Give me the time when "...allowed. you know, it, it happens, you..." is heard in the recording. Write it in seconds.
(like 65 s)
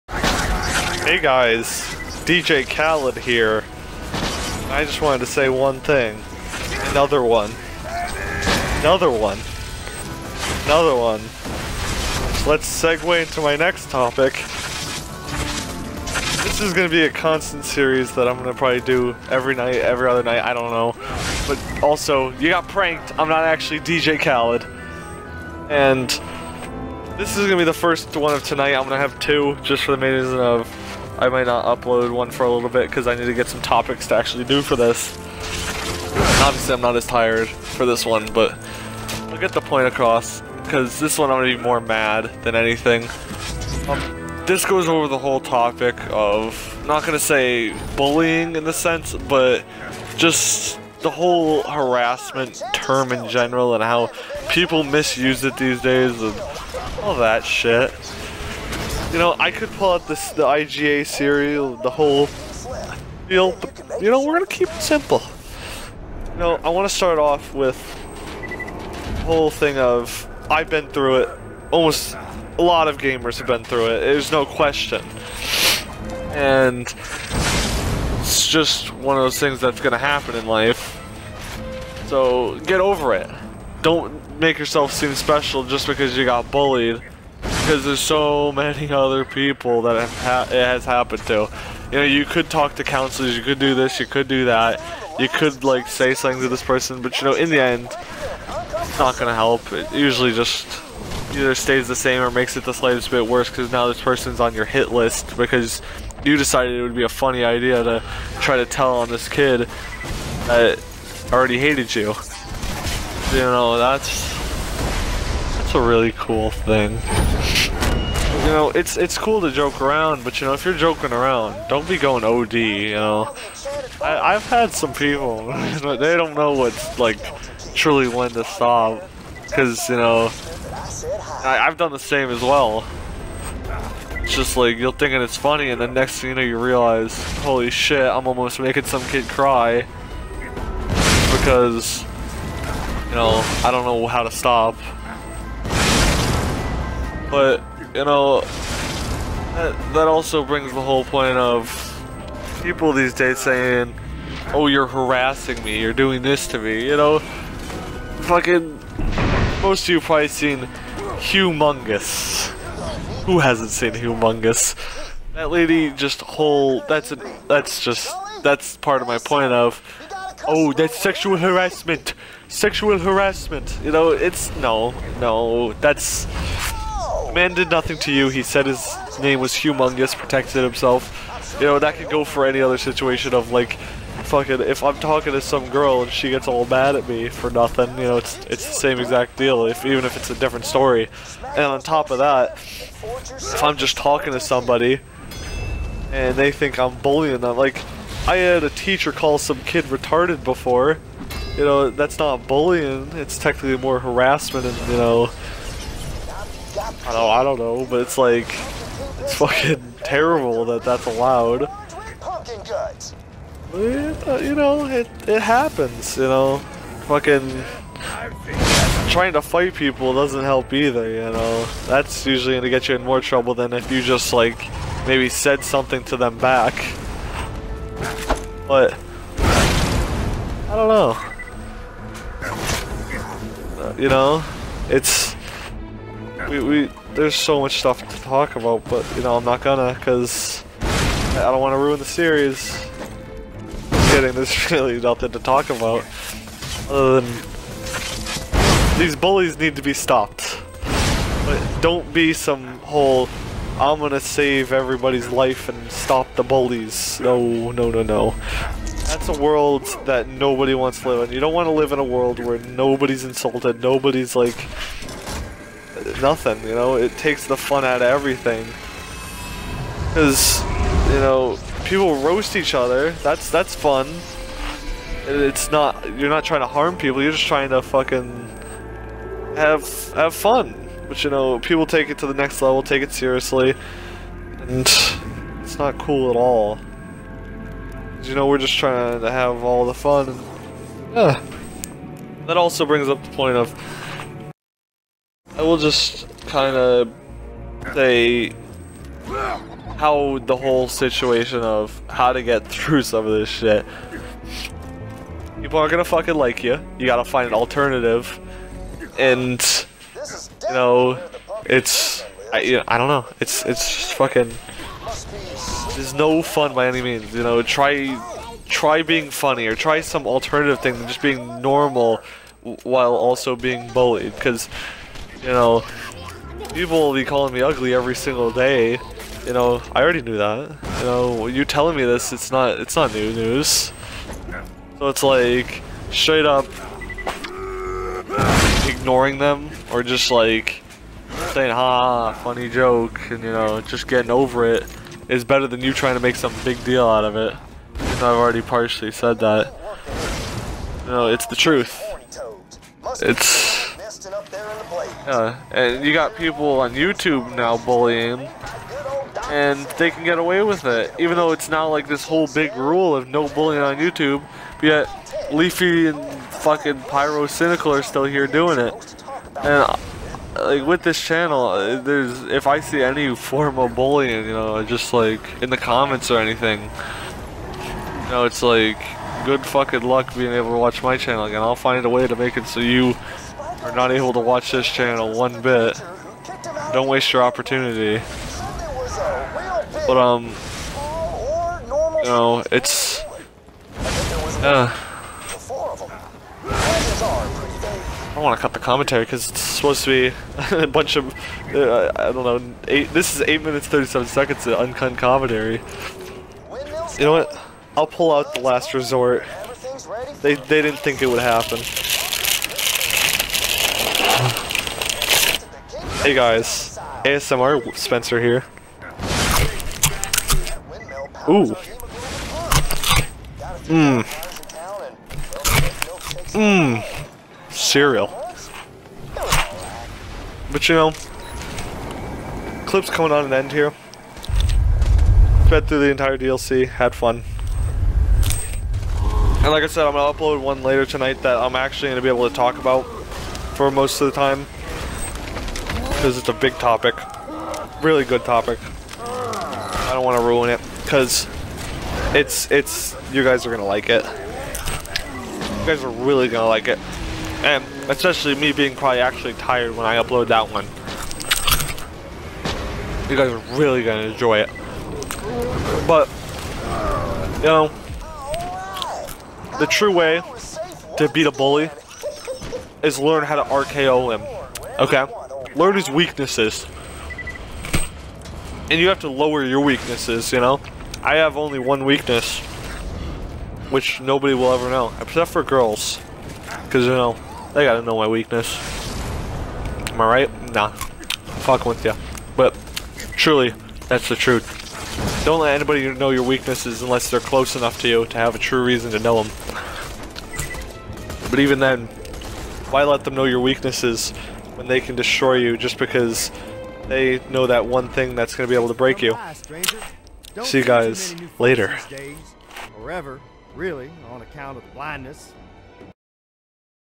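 211 s.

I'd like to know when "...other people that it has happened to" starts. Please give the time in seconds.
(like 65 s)
88 s.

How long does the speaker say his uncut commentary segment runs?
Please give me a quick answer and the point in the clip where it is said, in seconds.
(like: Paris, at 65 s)
8 minutes 37 seconds, at 403 s.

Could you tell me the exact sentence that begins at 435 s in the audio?
Sped through the entire DLC, had fun.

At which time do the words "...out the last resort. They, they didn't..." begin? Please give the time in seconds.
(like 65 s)
408 s.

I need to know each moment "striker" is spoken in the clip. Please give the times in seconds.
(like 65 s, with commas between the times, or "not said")
not said.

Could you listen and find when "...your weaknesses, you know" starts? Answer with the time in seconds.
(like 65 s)
479 s.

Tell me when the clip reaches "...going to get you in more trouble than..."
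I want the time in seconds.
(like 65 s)
222 s.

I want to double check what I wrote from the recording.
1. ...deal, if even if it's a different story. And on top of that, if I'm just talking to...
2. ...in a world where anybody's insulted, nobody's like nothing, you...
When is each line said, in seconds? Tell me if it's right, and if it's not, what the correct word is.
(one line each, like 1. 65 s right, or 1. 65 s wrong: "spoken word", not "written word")
1. 189 s right
2. 261 s wrong: "nobody", not "anybody".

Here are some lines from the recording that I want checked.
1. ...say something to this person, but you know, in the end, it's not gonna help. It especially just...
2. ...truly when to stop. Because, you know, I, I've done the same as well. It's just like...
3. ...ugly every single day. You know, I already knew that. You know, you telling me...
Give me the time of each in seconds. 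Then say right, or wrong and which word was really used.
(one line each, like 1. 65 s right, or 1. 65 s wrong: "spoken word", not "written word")
1. 95 s wrong: "usually", not "especially"
2. 127 s right
3. 327 s right.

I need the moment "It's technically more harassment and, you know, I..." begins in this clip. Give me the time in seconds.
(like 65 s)
203 s.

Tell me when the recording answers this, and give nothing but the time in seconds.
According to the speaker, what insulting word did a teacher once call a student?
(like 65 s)
199 s.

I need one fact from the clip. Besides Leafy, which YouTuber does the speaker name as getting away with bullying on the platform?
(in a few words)
Pyrocynical.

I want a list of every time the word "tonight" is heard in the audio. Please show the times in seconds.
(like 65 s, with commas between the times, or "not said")
28 s, 441 s.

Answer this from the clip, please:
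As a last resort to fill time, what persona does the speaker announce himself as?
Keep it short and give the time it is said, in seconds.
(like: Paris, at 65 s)
ASMR Spencer, at 417 s.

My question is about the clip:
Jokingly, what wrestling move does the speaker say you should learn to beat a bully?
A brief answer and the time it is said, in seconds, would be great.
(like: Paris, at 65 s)
RKO, at 473 s.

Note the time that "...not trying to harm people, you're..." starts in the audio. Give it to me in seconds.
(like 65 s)
276 s.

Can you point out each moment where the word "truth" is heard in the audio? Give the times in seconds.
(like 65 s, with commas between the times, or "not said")
351 s, 494 s.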